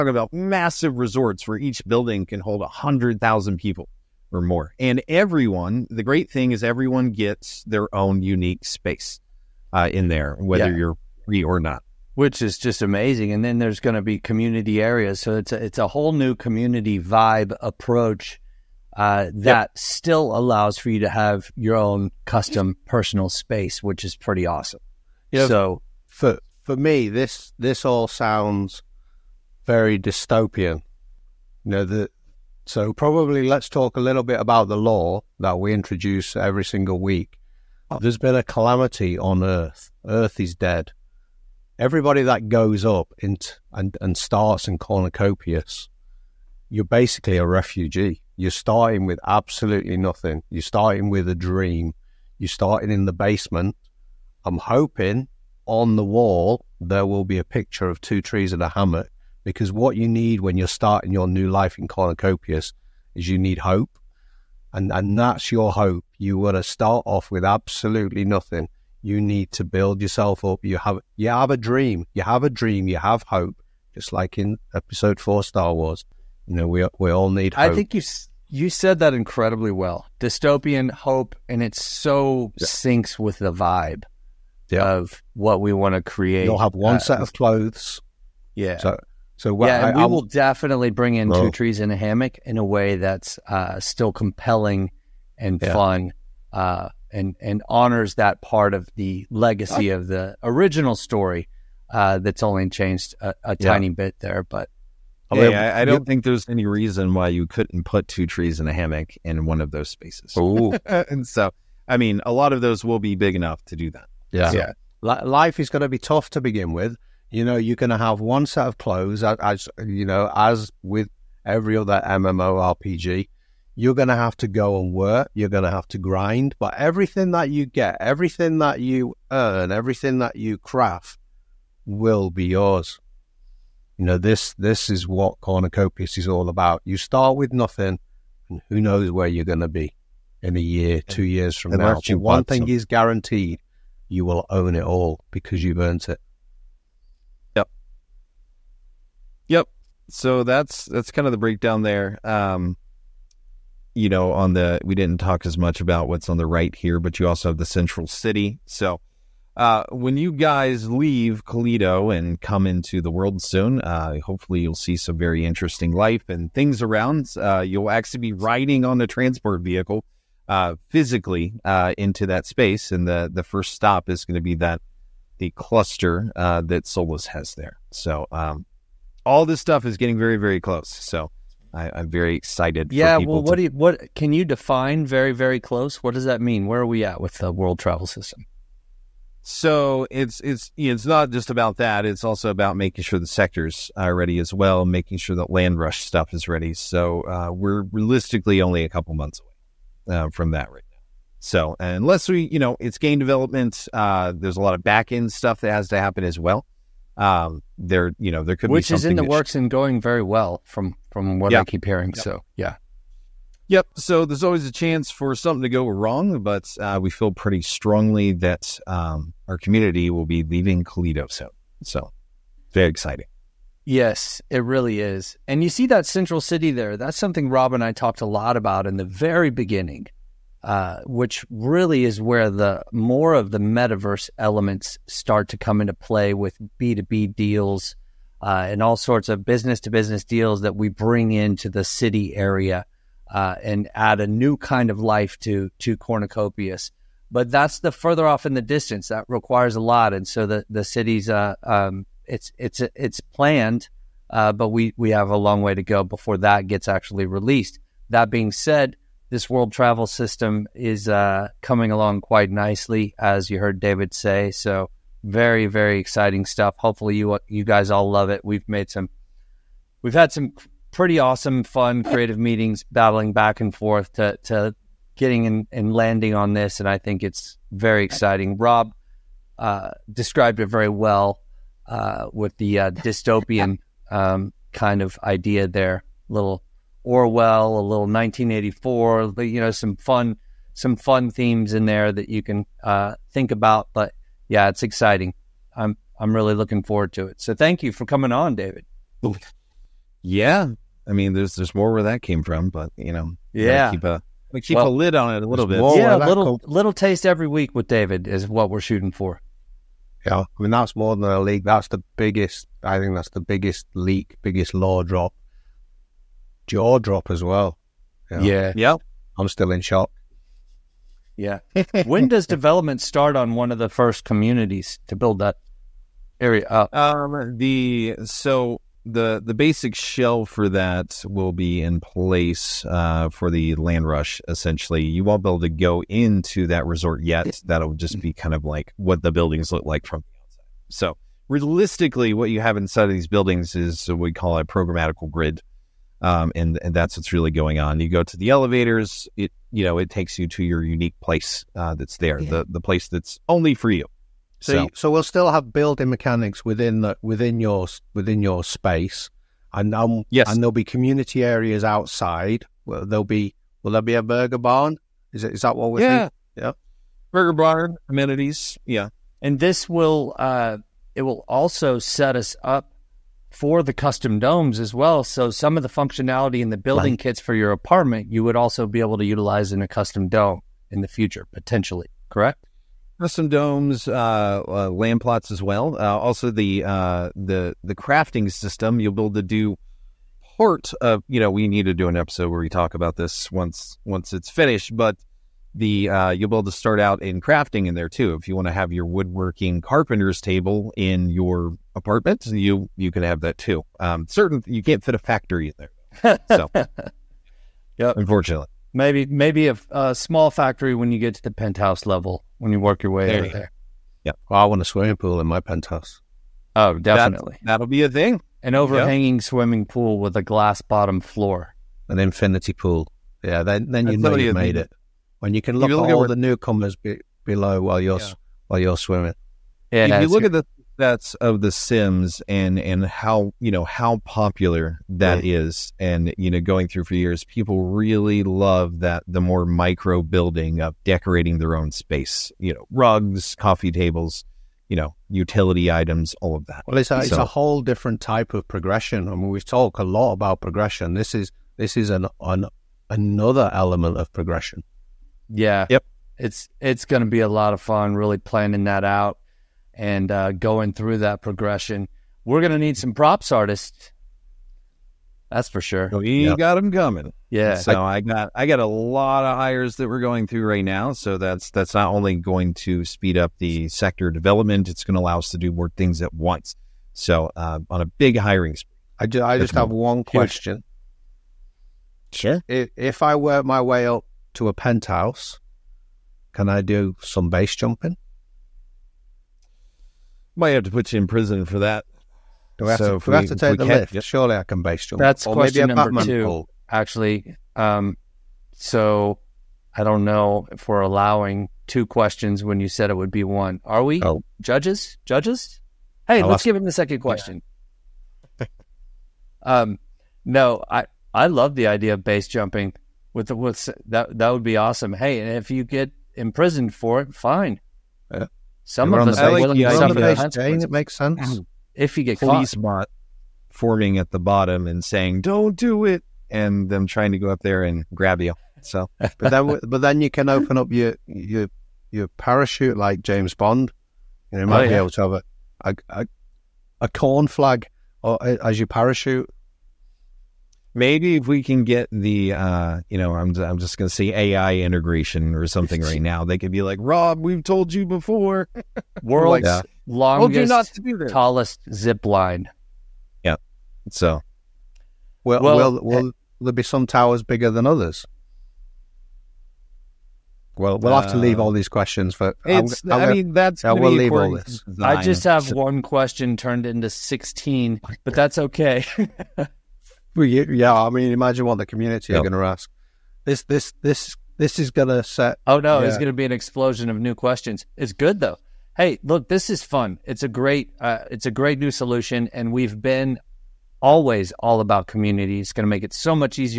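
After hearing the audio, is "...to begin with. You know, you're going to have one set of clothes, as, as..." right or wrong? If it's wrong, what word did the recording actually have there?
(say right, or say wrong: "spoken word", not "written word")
right.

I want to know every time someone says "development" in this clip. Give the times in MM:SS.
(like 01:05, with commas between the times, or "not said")
03:23, 05:22, 07:54.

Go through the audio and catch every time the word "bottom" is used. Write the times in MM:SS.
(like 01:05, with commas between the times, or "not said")
07:00, 08:44.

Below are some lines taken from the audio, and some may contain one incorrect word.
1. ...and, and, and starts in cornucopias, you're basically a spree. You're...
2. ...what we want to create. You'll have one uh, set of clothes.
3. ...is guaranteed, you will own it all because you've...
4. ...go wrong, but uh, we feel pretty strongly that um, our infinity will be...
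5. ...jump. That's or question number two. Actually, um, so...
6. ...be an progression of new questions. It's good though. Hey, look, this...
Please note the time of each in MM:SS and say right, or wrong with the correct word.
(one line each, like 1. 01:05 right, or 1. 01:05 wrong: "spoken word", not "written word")
1. 00:43 wrong: "refugee", not "spree"
2. 01:25 right
3. 02:22 right
4. 03:35 wrong: "community", not "infinity"
5. 08:15 right
6. 09:36 wrong: "explosion", not "progression".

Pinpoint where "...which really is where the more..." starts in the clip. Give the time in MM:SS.
03:51.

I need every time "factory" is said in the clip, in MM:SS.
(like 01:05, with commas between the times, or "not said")
06:45, 06:50.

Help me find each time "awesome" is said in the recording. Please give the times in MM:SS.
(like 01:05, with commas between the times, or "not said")
00:24, 04:31, 08:34.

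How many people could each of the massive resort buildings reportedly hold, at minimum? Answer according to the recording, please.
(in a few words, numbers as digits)
100,000.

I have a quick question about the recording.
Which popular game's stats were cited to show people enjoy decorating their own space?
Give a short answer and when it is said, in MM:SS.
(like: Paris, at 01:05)
The Sims, at 07:11.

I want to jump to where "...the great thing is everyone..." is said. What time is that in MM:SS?
00:05.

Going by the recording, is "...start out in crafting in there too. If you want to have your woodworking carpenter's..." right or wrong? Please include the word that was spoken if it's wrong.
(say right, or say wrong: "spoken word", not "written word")
right.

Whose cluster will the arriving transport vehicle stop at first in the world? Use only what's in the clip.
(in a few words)
Solus.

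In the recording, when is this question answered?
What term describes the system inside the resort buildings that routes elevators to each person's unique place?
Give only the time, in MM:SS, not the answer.
05:44.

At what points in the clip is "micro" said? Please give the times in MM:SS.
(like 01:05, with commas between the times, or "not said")
07:19.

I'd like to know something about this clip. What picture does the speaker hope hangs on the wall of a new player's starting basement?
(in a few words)
Two trees and a hammock.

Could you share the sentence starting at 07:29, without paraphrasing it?
I mean, we talk a lot about progression.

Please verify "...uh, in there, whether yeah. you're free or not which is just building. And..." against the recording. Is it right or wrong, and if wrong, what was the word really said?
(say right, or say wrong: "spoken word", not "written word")
wrong: "amazing", not "building".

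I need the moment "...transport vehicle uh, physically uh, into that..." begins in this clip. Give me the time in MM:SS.
02:49.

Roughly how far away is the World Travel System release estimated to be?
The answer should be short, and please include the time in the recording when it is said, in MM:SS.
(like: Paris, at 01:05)
A couple months, at 03:18.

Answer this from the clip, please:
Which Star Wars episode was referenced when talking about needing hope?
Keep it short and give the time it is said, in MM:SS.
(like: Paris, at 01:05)
Episode four, at 01:14.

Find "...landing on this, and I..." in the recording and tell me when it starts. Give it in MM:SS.
04:35.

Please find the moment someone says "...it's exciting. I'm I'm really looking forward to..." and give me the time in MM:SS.
04:54.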